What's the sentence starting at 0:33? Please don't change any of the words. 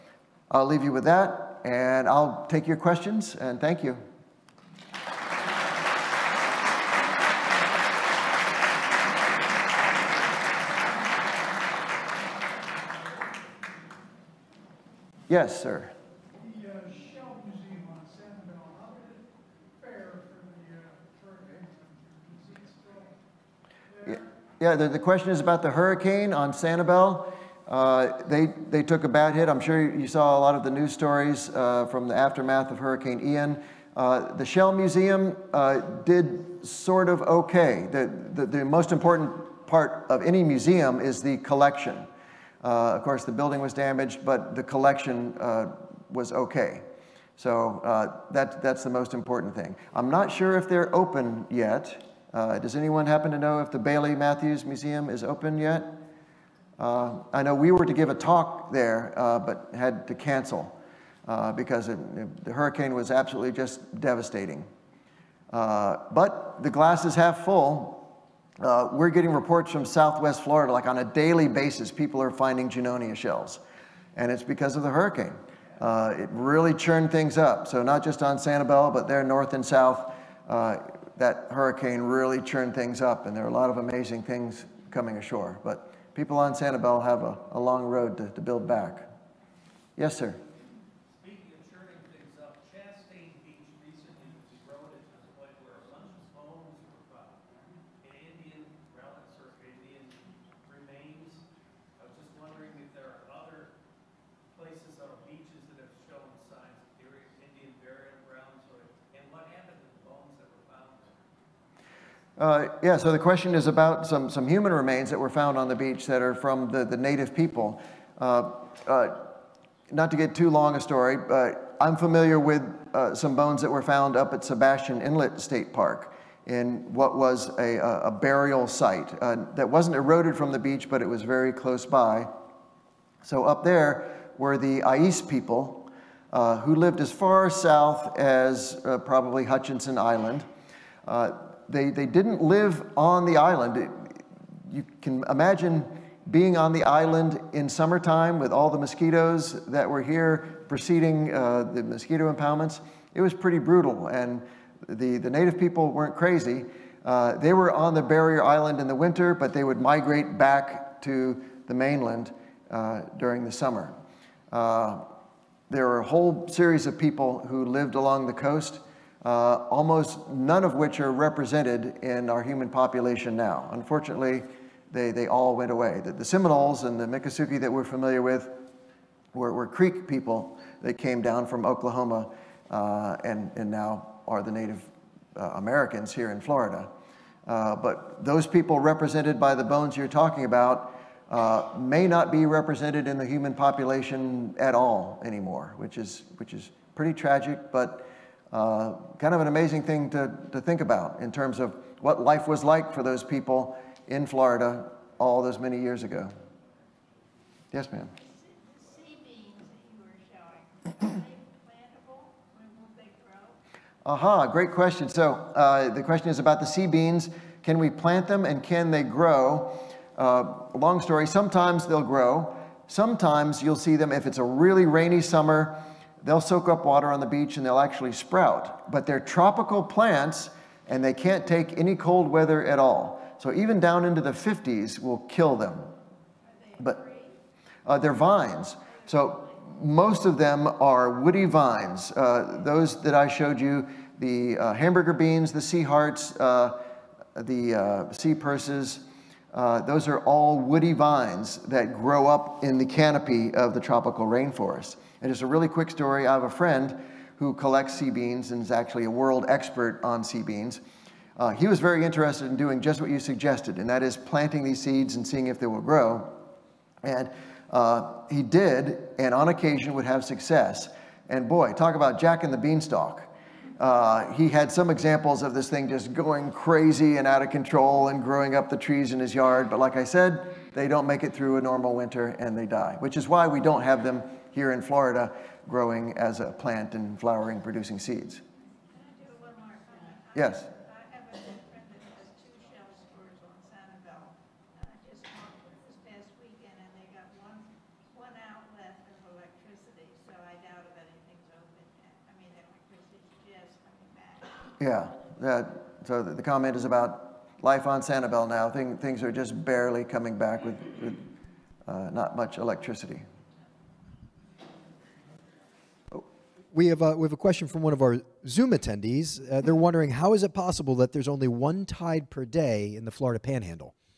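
Uh, the Shell Museum uh, did sort of okay.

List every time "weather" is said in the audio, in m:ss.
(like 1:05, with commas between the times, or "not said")
3:52.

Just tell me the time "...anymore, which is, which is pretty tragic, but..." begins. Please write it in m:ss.
3:15.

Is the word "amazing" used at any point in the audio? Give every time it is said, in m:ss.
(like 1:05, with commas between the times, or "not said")
1:23, 3:19.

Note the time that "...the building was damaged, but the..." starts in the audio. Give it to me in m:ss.
0:43.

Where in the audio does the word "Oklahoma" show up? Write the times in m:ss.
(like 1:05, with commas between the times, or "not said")
3:01.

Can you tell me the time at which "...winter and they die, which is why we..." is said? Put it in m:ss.
4:41.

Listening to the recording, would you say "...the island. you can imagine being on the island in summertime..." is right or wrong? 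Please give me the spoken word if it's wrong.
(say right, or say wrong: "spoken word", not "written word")
right.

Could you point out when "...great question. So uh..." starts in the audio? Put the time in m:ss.
3:34.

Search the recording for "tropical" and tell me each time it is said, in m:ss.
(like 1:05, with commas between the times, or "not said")
3:49, 4:13.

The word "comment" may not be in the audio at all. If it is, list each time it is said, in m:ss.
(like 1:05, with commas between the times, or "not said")
5:06.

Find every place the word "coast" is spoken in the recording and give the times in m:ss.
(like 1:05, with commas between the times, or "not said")
2:48.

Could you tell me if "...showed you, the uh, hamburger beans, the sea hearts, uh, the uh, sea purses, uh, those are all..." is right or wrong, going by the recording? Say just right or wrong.
right.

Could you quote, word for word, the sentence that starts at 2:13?
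So up there were the Ais people who lived as far south as probably Hutchinson Island.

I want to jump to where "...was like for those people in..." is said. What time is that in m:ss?
3:22.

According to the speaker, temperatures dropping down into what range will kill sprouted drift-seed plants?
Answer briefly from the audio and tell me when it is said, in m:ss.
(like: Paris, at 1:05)
the 50s, at 3:54.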